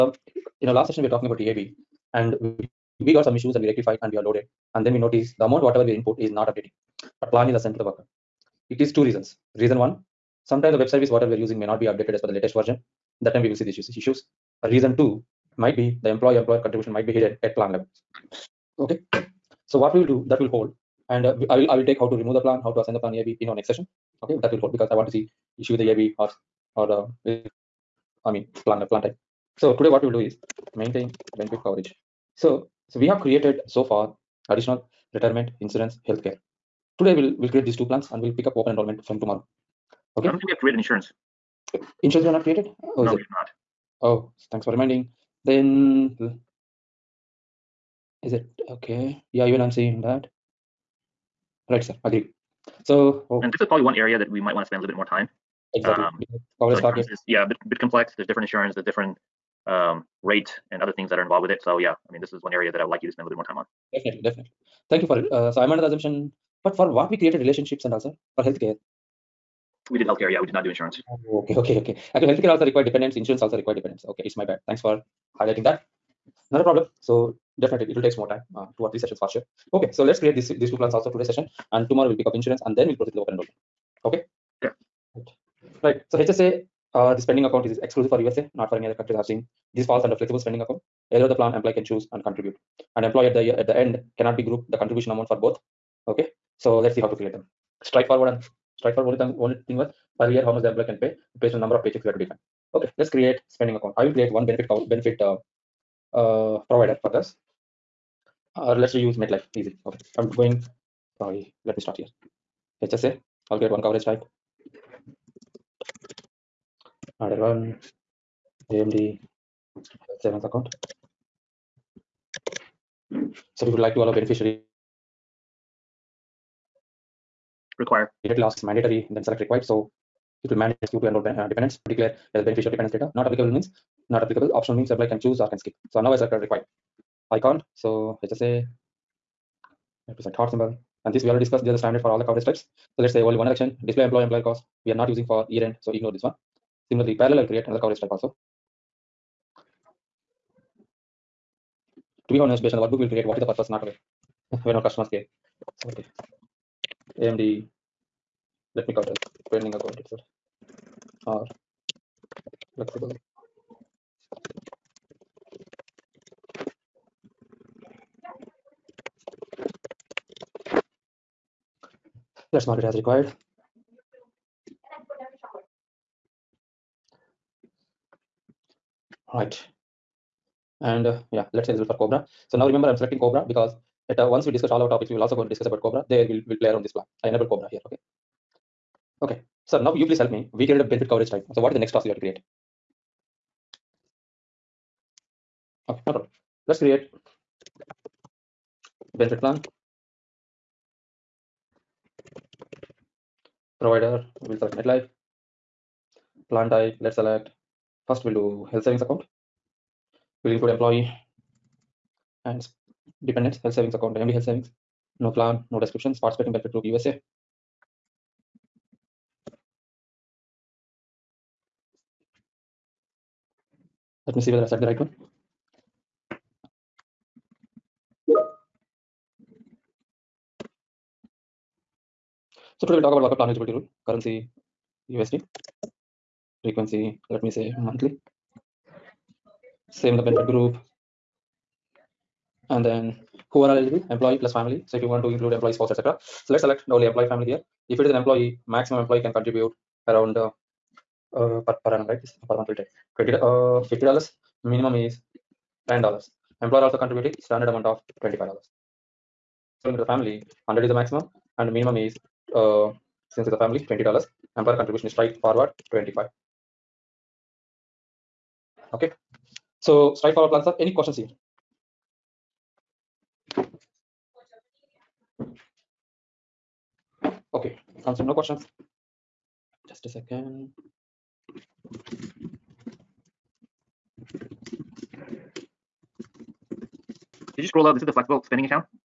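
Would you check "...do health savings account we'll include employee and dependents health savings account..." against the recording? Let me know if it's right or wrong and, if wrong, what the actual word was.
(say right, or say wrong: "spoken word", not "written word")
right.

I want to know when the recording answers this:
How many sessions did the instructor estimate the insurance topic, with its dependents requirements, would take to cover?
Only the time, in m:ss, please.
1:18.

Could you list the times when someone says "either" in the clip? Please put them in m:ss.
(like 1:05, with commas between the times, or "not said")
1:31, 2:12.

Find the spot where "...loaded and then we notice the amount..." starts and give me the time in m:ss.
0:04.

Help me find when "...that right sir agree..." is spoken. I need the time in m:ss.
0:50.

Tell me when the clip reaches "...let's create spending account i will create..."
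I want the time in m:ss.
1:43.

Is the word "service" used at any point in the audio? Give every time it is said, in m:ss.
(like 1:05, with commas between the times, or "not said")
0:10.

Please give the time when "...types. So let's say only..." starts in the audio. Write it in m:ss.
2:22.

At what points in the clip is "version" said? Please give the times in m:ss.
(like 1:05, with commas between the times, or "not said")
0:12.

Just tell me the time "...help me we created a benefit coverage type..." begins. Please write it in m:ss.
3:10.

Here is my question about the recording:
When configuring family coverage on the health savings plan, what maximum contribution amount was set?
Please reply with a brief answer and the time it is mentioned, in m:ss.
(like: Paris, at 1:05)
100, at 4:20.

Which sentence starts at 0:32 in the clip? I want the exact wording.
So, so we have created so far additional retirement, insurance, healthcare.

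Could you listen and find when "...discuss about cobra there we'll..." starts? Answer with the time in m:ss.
3:05.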